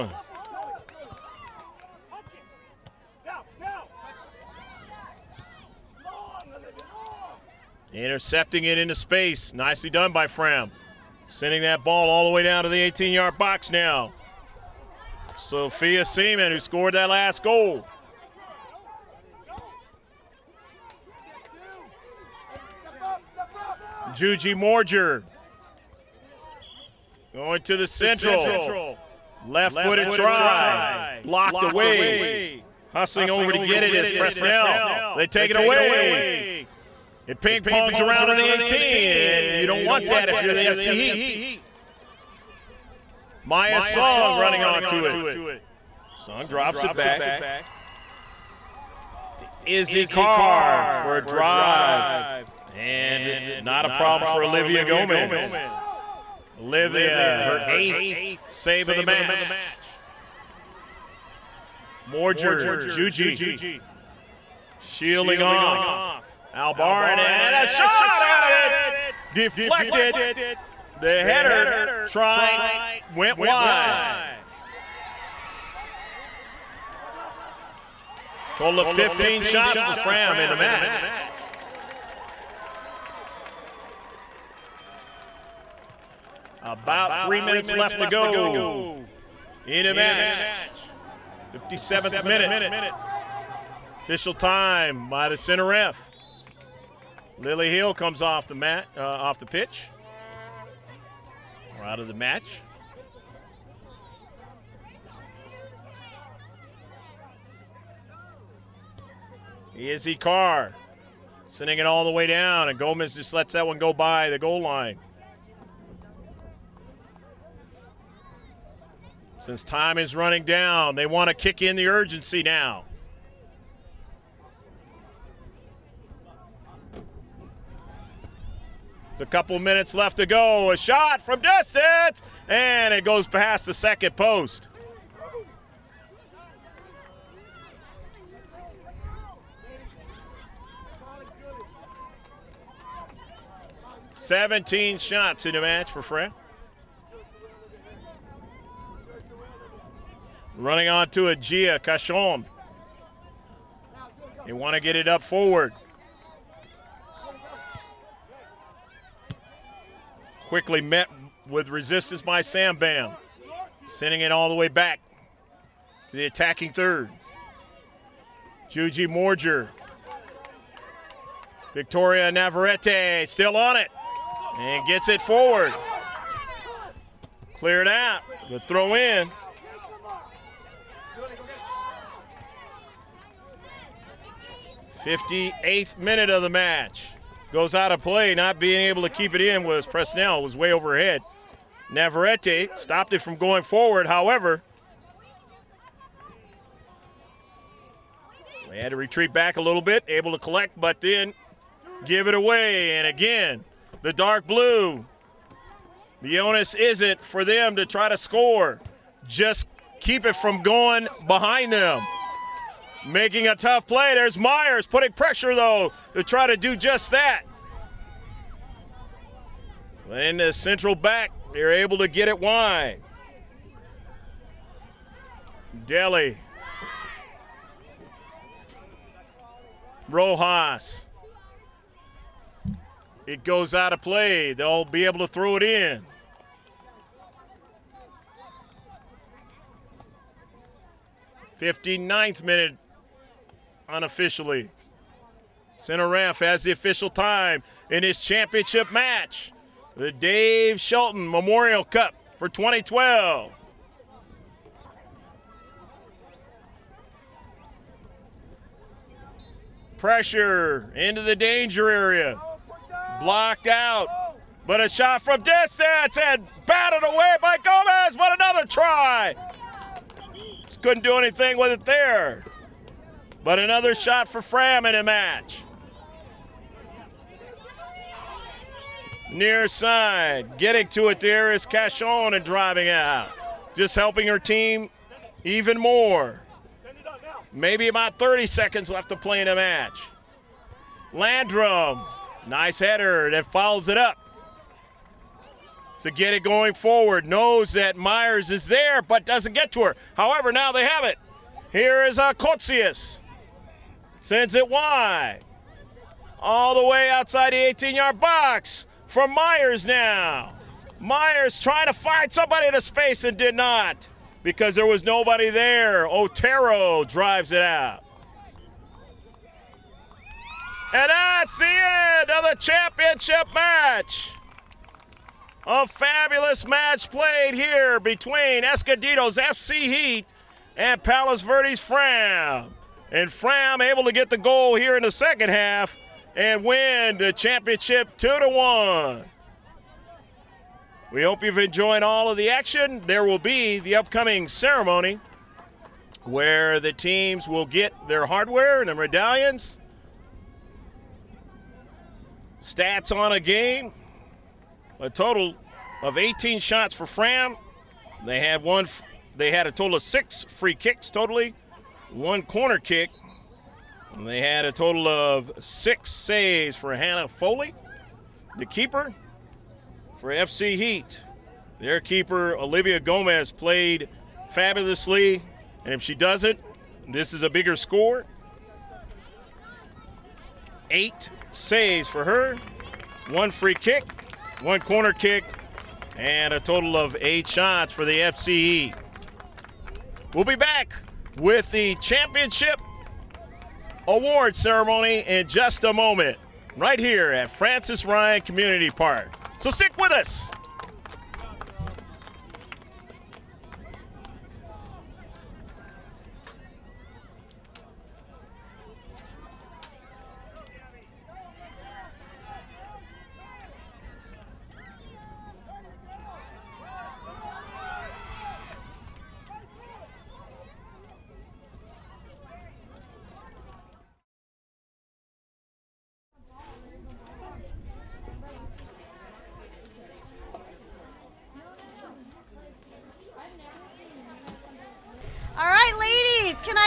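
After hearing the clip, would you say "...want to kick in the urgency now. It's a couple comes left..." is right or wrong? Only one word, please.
wrong.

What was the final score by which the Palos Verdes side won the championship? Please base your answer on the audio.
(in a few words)
2 to 1.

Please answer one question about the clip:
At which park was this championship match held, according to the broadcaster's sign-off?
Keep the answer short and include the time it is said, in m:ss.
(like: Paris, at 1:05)
Frances Ryan Community Park, at 6:37.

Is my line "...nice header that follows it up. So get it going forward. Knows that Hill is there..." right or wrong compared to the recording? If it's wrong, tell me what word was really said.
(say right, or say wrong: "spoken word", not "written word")
wrong: "Myers", not "Hill".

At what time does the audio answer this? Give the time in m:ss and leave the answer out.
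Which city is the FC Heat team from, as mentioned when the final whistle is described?
5:28.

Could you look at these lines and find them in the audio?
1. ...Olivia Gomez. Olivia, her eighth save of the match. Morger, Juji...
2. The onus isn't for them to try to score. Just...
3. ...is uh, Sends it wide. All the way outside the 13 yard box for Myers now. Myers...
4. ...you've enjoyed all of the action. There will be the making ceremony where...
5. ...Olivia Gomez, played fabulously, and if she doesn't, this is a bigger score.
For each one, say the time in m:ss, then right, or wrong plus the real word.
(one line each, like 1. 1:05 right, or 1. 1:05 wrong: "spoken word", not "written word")
1. 0:54 right
2. 3:26 right
3. 5:02 wrong: "18", not "13"
4. 5:41 wrong: "upcoming", not "making"
5. 6:12 right.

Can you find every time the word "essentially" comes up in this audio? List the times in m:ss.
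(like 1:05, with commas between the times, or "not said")
not said.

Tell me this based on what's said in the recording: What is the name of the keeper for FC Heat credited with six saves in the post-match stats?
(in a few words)
Hannah Foley.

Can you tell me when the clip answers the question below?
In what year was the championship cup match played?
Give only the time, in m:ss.
4:12.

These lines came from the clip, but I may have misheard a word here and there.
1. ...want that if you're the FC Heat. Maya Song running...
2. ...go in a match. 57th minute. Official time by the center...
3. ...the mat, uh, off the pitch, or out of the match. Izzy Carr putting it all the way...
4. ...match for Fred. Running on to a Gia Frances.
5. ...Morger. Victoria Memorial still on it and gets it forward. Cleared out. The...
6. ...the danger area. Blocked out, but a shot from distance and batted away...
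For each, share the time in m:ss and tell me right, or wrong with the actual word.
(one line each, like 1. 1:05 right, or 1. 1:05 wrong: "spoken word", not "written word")
1. 0:39 right
2. 1:28 right
3. 1:38 wrong: "sending", not "putting"
4. 2:25 wrong: "Cachon", not "Frances"
5. 2:49 wrong: "Navarrete", not "Memorial"
6. 4:21 right.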